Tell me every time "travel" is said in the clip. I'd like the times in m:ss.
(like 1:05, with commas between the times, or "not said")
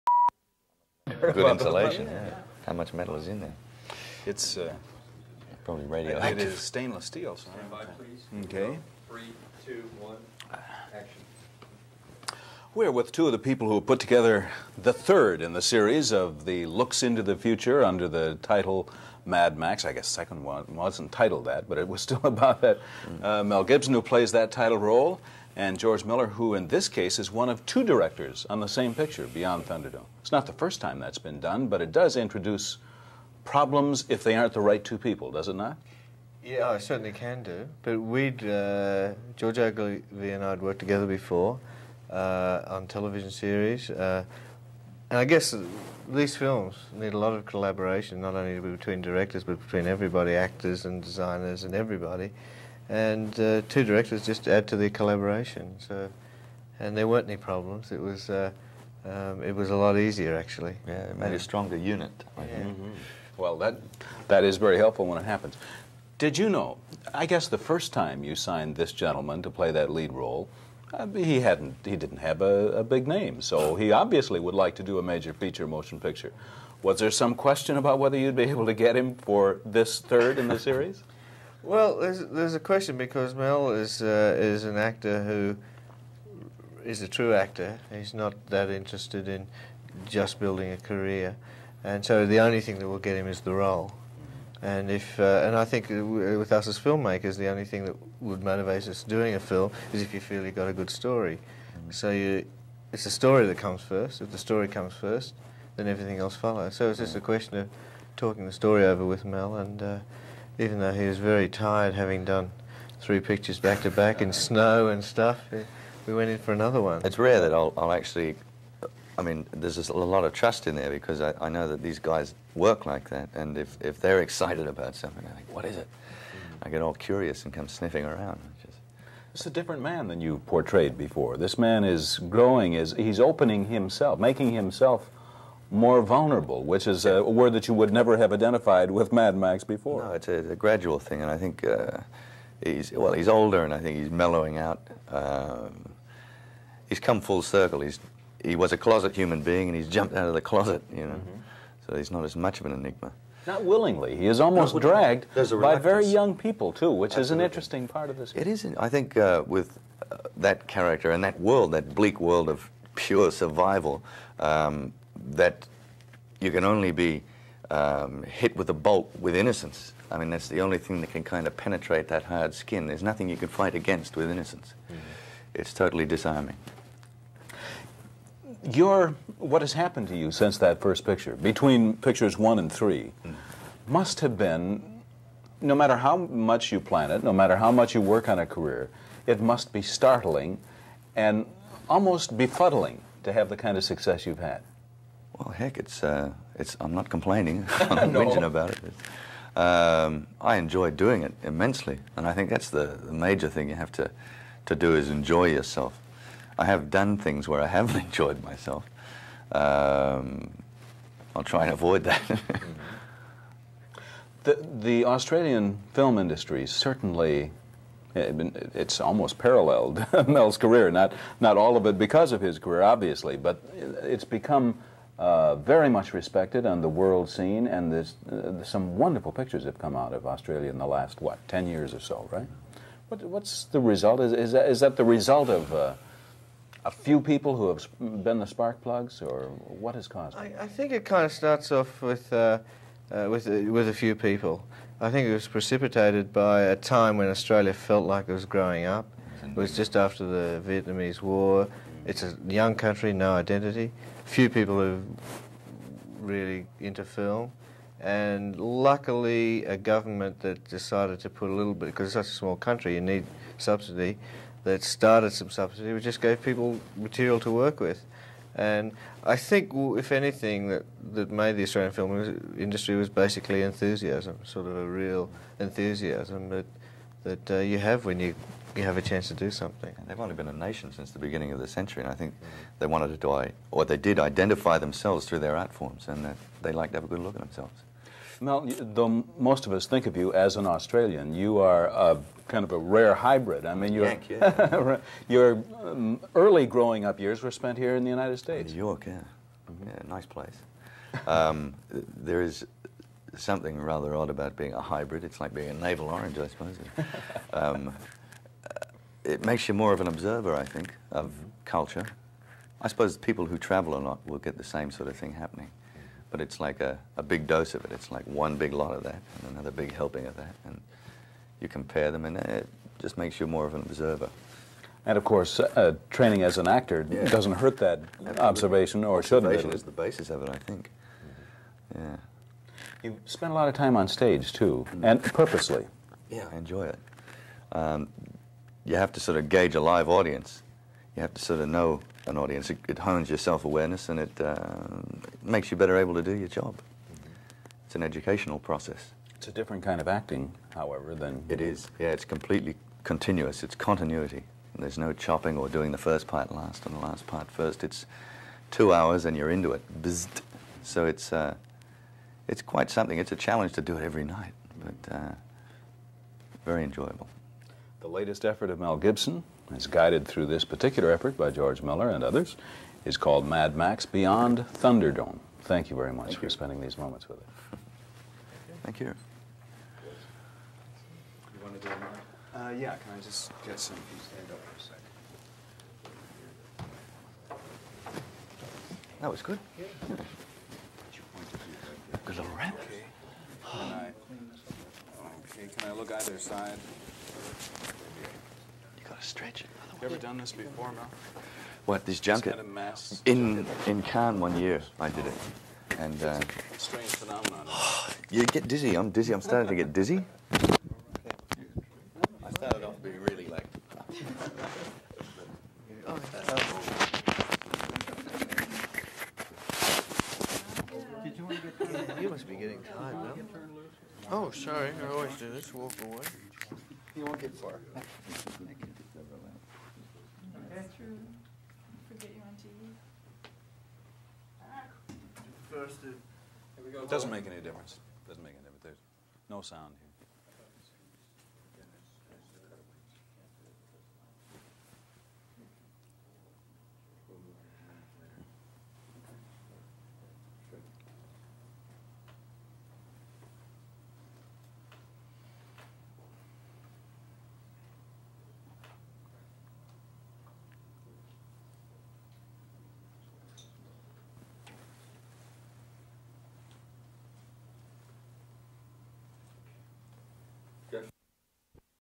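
5:13.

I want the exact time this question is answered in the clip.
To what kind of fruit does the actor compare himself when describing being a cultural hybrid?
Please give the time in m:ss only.
5:05.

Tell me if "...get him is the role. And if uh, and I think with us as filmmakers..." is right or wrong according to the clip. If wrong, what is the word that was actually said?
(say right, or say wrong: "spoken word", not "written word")
right.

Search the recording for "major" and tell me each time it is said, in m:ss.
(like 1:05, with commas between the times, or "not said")
1:15, 3:23.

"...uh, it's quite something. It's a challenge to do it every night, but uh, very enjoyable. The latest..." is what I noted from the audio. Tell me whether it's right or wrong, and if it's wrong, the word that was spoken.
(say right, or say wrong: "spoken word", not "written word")
right.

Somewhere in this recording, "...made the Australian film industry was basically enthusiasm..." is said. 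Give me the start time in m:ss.
4:31.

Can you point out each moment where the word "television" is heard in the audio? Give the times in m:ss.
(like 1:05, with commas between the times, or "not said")
0:42.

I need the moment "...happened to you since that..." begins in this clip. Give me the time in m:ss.
2:59.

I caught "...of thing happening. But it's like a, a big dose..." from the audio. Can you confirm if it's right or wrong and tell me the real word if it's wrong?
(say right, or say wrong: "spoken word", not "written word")
right.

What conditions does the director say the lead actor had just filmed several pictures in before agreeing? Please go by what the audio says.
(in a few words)
snow.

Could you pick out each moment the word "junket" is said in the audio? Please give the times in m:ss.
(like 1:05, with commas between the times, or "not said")
6:42.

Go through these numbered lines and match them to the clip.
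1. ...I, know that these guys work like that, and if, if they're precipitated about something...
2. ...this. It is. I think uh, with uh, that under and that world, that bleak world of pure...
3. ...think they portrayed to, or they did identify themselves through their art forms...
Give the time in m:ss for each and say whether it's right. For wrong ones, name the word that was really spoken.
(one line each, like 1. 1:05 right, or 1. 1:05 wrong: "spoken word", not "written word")
1. 2:01 wrong: "excited", not "precipitated"
2. 2:38 wrong: "character", not "under"
3. 4:42 wrong: "wanted", not "portrayed".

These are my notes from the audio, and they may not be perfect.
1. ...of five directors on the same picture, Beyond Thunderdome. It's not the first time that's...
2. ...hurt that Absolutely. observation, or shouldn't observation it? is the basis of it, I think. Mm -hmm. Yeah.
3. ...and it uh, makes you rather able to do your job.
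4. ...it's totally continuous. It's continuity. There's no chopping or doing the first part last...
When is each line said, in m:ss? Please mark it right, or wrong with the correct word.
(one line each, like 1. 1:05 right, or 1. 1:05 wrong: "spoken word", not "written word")
1. 0:27 wrong: "two", not "five"
2. 5:27 right
3. 5:44 wrong: "better", not "rather"
4. 5:52 wrong: "completely", not "totally".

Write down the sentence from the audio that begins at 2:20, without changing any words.
No, it's a, it's a gradual thing, and I think uh, he's well, he's older, and I think he's mellowing out.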